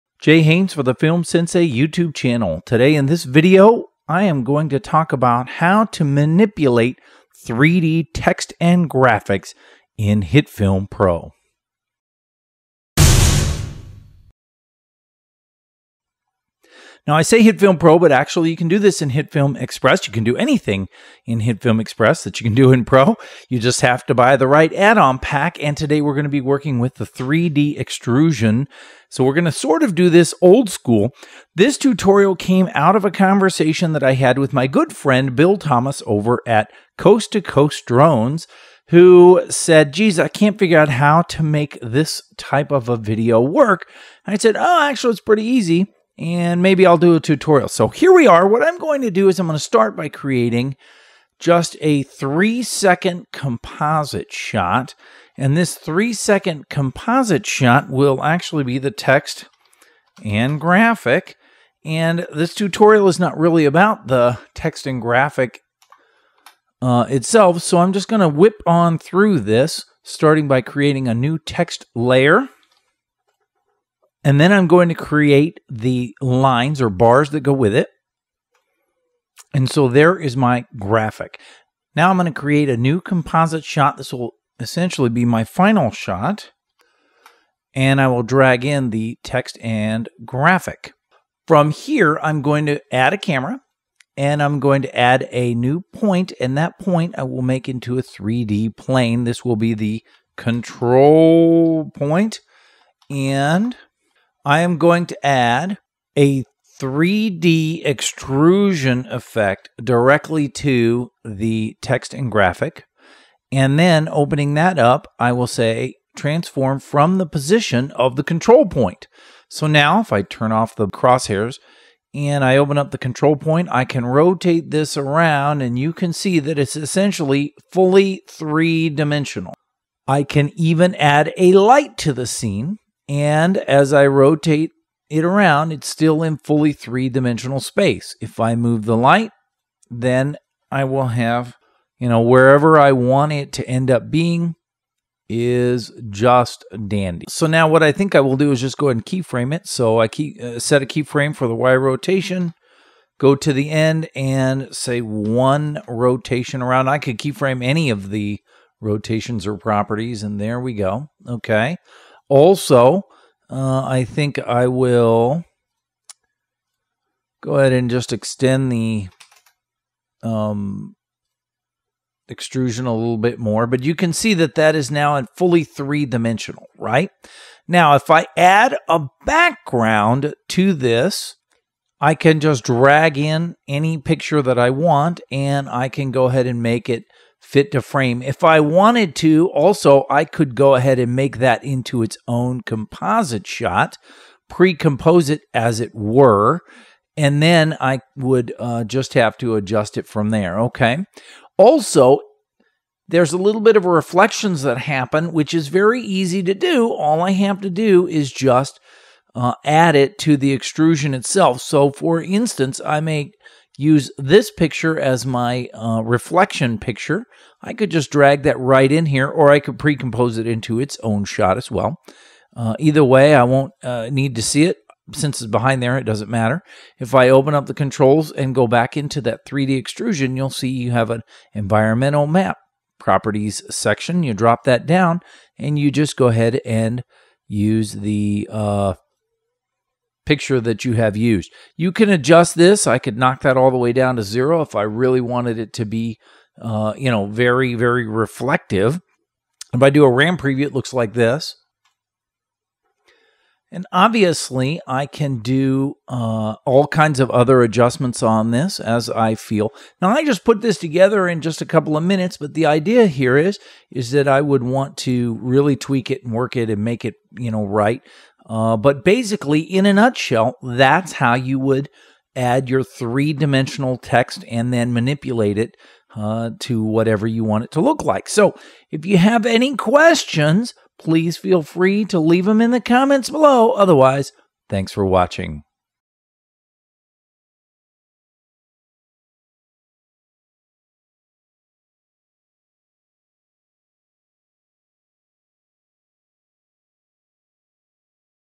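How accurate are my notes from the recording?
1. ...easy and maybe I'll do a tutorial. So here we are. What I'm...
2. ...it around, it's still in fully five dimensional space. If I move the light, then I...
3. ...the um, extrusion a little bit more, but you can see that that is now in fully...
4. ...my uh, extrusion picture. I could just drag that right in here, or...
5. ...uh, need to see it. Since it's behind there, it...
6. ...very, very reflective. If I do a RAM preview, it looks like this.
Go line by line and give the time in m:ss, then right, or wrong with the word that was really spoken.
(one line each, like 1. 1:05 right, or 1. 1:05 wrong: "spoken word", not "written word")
1. 0:45 right
2. 2:15 wrong: "three", not "five"
3. 2:48 right
4. 3:35 wrong: "reflection", not "extrusion"
5. 3:43 right
6. 4:07 right.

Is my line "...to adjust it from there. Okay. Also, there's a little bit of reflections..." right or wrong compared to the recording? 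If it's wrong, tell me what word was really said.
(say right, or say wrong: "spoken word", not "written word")
right.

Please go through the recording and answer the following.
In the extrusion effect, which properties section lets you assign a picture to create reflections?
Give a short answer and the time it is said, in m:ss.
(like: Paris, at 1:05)
environmental map, at 3:51.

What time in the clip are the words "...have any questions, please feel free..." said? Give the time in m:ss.
4:39.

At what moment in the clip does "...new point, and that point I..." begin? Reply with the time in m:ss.
1:35.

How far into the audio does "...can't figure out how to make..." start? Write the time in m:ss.
0:40.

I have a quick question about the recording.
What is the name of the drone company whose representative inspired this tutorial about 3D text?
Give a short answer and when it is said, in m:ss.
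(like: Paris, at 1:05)
Coast to Coast Drones, at 0:36.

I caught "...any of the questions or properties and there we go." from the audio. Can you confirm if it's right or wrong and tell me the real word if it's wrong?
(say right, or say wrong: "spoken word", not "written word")
wrong: "rotations", not "questions".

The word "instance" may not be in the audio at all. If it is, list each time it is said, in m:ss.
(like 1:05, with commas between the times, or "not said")
3:32.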